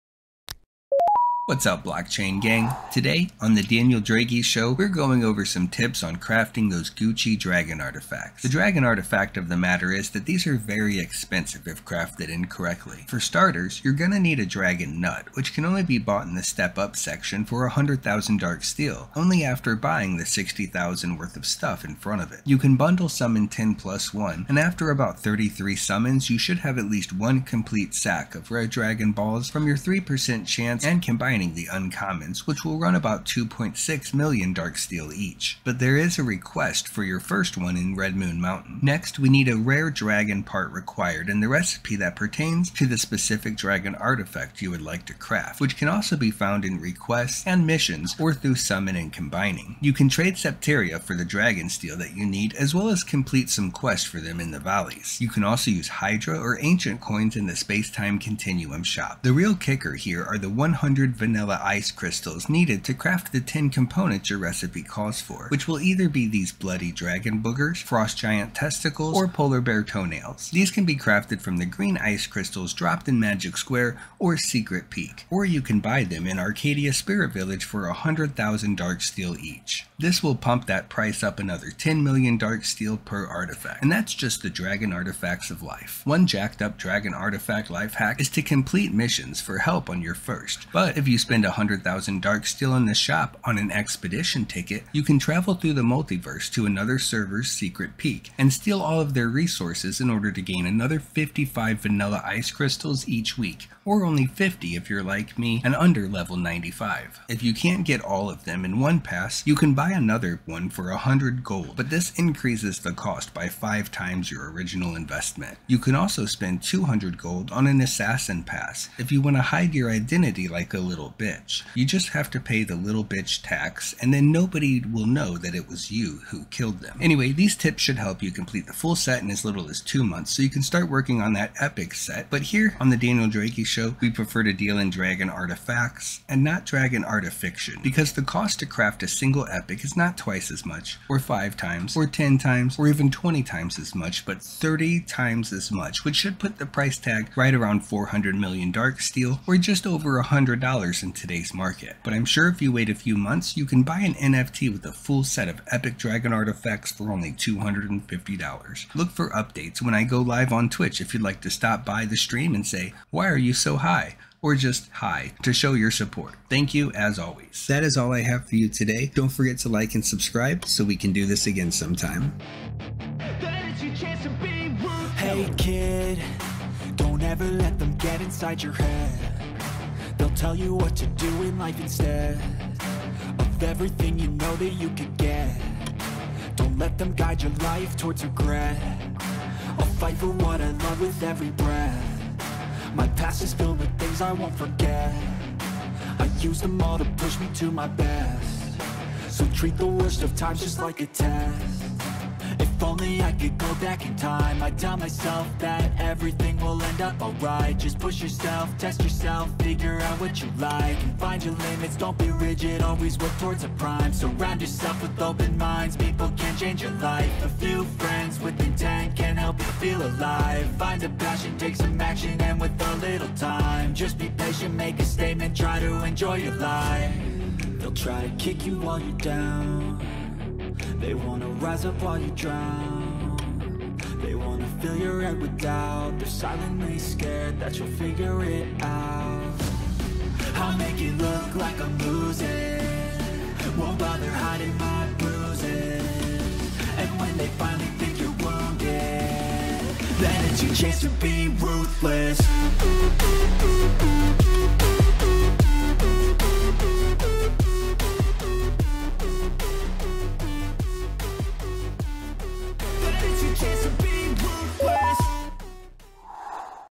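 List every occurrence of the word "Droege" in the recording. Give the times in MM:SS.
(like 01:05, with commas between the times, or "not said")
00:03, 02:13.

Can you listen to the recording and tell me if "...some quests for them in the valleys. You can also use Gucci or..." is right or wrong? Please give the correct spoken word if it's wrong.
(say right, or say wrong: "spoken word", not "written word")
wrong: "Hydra", not "Gucci".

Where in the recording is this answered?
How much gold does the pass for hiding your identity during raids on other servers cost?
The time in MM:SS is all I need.
01:56.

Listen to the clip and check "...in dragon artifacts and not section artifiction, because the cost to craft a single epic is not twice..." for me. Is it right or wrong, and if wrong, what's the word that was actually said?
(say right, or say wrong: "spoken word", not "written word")
wrong: "dragon", not "section".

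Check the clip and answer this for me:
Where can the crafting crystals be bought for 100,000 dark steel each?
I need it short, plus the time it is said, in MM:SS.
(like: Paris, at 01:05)
Arcadia Spirit Village, at 01:16.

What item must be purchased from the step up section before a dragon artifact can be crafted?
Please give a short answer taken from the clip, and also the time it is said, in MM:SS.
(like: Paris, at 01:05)
dragon nut, at 00:14.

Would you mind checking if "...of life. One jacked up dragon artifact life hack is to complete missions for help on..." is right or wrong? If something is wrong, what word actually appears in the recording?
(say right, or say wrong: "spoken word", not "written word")
right.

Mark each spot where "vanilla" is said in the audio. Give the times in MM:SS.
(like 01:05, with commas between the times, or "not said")
01:01, 01:41.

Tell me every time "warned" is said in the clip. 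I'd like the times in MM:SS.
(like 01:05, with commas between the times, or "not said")
not said.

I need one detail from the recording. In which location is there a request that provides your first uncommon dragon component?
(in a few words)
Red Moon Mountain.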